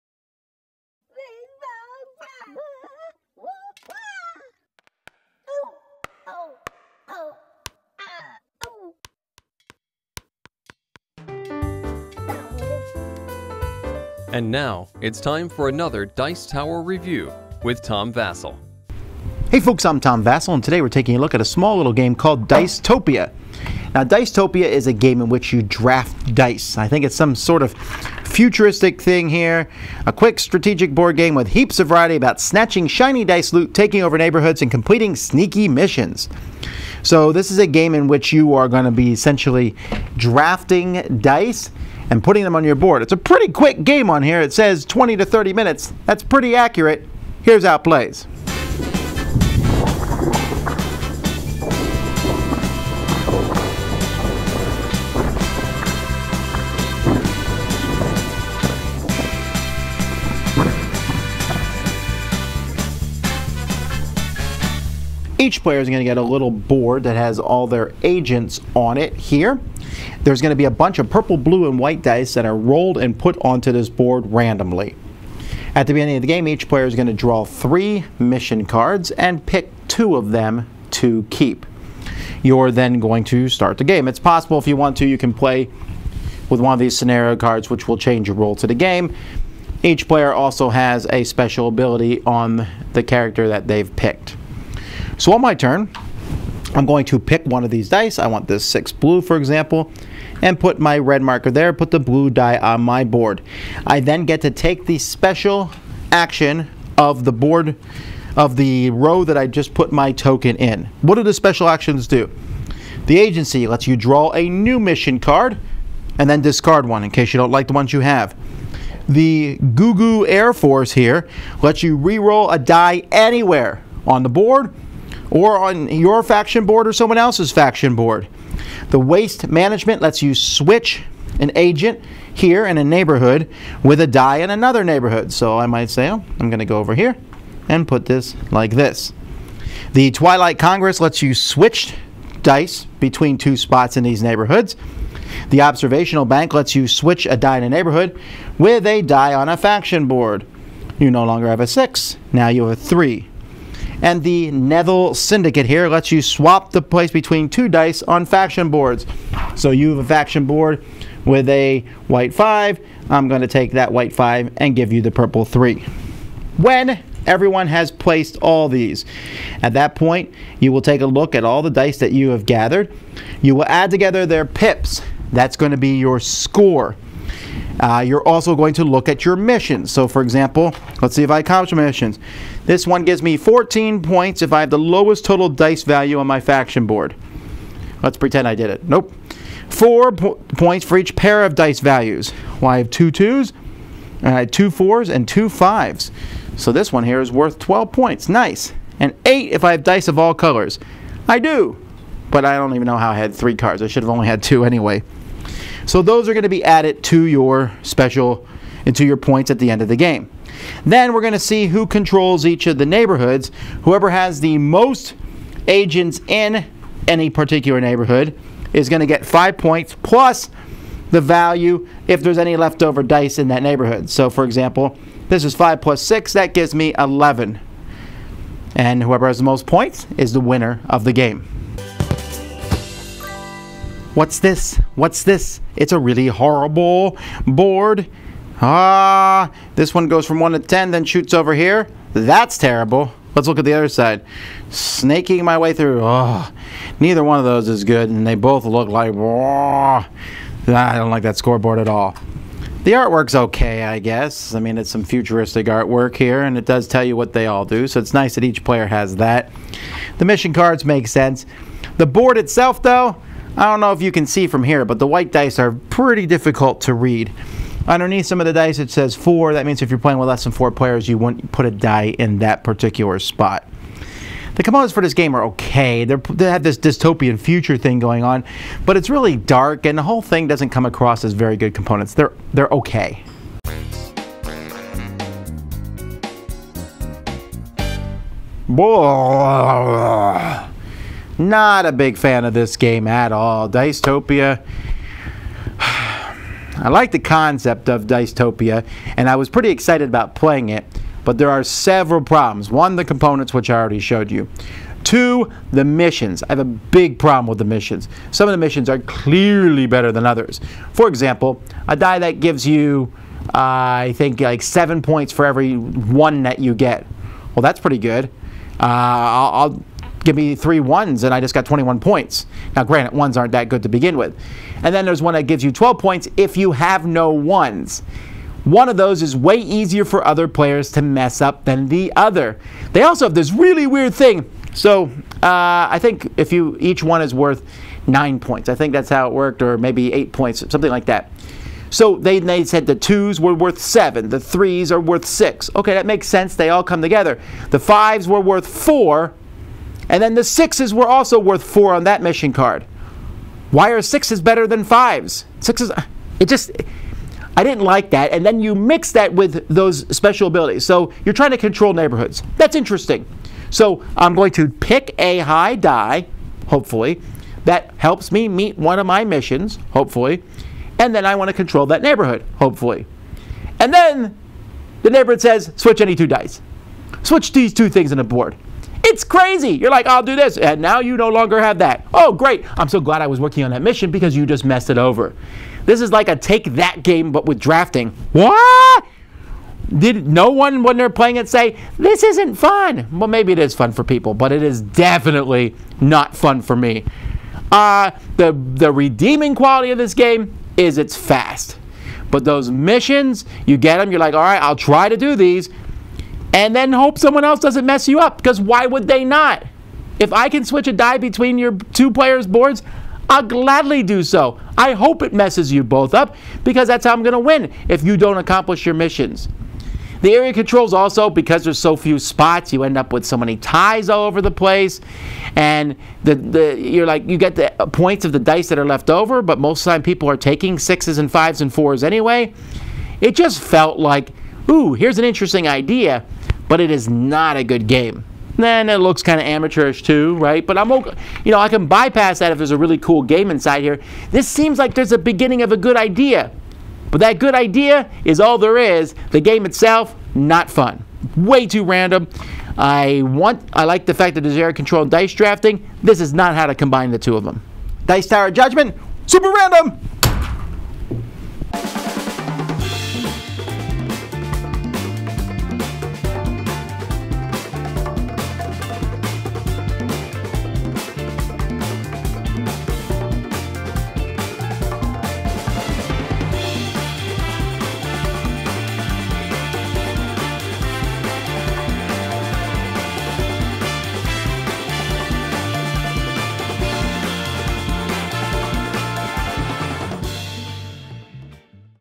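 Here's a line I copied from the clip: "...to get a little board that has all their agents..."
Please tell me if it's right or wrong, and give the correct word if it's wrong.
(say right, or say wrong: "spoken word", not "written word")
right.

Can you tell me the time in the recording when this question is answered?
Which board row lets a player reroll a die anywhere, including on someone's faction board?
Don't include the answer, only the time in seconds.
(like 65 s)
119 s.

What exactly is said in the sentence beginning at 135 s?
So I might say, oh, I'm going to go over here and put this like this.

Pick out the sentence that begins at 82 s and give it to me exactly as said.
You're then going to start the game.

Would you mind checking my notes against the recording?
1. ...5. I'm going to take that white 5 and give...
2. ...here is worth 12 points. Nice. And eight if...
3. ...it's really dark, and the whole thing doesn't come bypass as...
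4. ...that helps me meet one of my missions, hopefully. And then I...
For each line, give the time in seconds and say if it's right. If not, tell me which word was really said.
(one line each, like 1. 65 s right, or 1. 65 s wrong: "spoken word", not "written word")
1. 162 s right
2. 197 s right
3. 278 s wrong: "across", not "bypass"
4. 367 s right.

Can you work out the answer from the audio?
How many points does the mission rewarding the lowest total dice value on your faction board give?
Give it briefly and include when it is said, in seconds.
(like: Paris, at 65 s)
14, at 183 s.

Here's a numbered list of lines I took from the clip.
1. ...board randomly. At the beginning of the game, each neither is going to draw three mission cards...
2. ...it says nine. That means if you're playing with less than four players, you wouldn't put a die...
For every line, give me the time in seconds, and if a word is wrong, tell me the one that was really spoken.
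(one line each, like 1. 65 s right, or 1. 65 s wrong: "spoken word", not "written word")
1. 73 s wrong: "player", not "neither"
2. 268 s wrong: "four", not "nine".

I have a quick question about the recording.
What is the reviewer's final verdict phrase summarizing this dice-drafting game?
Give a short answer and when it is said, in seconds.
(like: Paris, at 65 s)
super random, at 459 s.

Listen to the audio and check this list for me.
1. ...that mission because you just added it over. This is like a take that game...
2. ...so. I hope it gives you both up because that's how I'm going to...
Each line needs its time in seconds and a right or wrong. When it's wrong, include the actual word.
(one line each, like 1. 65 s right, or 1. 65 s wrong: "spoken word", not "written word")
1. 383 s wrong: "messed", not "added"
2. 414 s wrong: "messes", not "gives".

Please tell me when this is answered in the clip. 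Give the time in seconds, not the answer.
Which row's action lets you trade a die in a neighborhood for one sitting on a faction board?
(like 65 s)
145 s.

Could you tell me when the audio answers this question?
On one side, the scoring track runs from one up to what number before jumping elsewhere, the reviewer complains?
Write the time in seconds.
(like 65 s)
240 s.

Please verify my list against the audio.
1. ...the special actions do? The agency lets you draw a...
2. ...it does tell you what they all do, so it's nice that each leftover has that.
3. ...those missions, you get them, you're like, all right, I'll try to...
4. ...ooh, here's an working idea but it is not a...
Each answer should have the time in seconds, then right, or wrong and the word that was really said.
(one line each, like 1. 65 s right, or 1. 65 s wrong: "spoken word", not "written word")
1. 111 s right
2. 256 s wrong: "player", not "leftover"
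3. 402 s right
4. 434 s wrong: "interesting", not "working".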